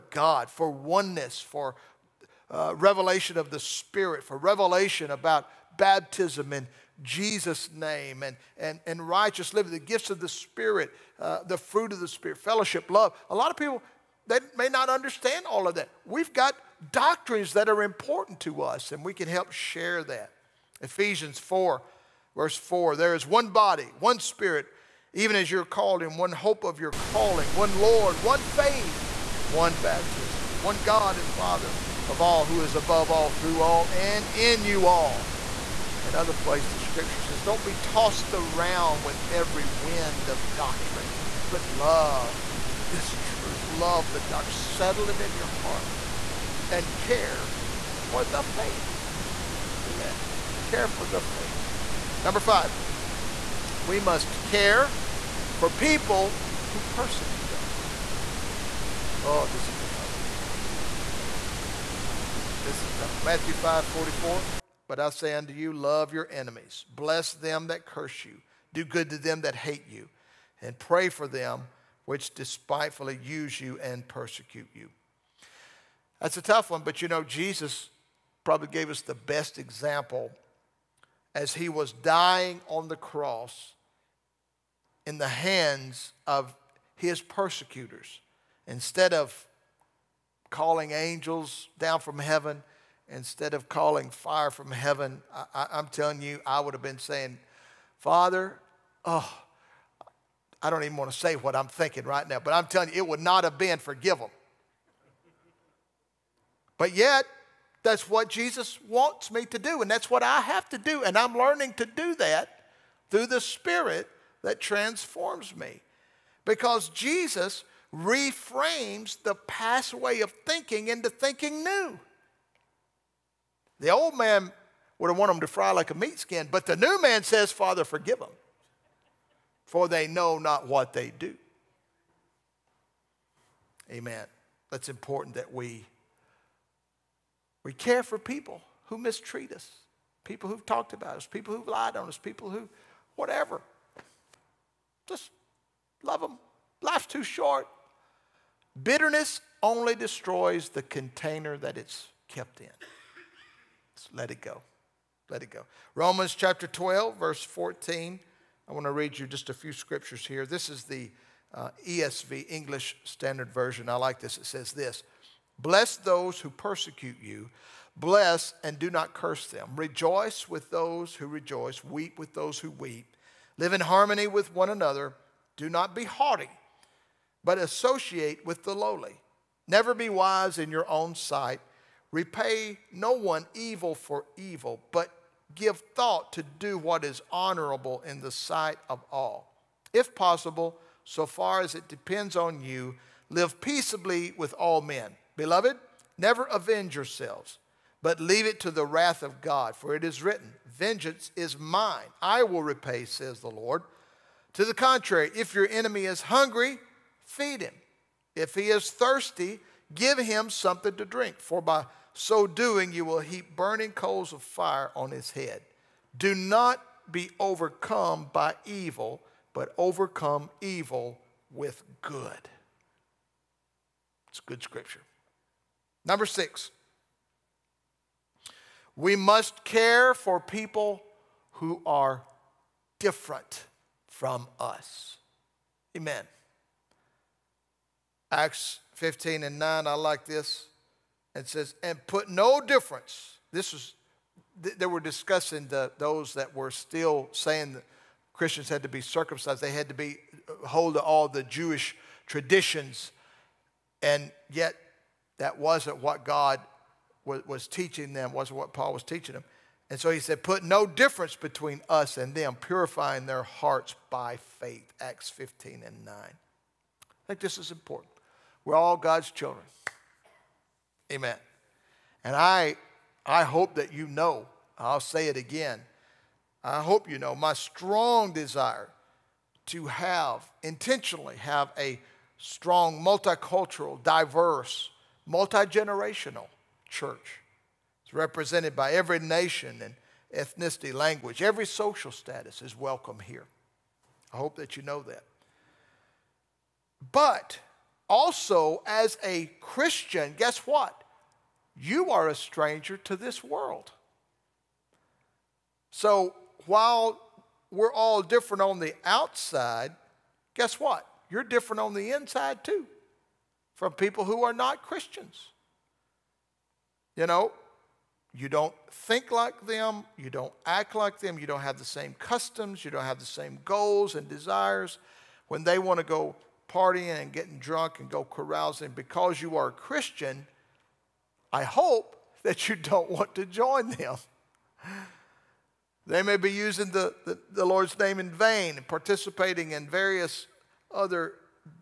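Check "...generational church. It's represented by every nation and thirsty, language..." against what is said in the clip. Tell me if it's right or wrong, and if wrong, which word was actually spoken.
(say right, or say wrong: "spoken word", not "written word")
wrong: "ethnicity", not "thirsty".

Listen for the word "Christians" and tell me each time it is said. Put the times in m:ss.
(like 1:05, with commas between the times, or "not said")
4:08, 4:59, 5:14, 5:29.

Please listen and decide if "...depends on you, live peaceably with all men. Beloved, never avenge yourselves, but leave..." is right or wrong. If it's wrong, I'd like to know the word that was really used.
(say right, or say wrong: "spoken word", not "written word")
right.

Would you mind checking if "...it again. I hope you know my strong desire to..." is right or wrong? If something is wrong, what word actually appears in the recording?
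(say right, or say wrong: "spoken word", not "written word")
right.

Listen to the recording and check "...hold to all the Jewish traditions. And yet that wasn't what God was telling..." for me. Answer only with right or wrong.
wrong.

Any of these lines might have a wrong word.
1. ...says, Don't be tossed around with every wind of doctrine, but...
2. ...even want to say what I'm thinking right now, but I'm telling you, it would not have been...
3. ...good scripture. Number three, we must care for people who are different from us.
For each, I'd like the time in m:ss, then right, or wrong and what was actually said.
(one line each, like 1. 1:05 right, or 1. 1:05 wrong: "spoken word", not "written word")
1. 0:37 right
2. 1:40 right
3. 3:44 wrong: "six", not "three".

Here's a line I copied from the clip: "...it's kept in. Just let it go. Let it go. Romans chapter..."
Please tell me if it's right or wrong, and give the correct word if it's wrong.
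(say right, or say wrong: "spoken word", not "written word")
right.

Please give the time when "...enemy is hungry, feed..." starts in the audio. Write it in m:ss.
3:25.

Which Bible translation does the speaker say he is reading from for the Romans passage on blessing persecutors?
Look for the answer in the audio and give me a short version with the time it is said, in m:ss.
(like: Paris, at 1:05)
English Standard Version, at 2:42.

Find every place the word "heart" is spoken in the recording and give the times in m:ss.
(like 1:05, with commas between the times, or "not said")
0:45, 4:23.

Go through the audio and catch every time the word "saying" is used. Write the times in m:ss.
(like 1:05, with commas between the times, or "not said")
1:36, 4:07.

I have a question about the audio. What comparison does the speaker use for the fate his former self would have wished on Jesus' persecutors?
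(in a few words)
Fry like a meat skin.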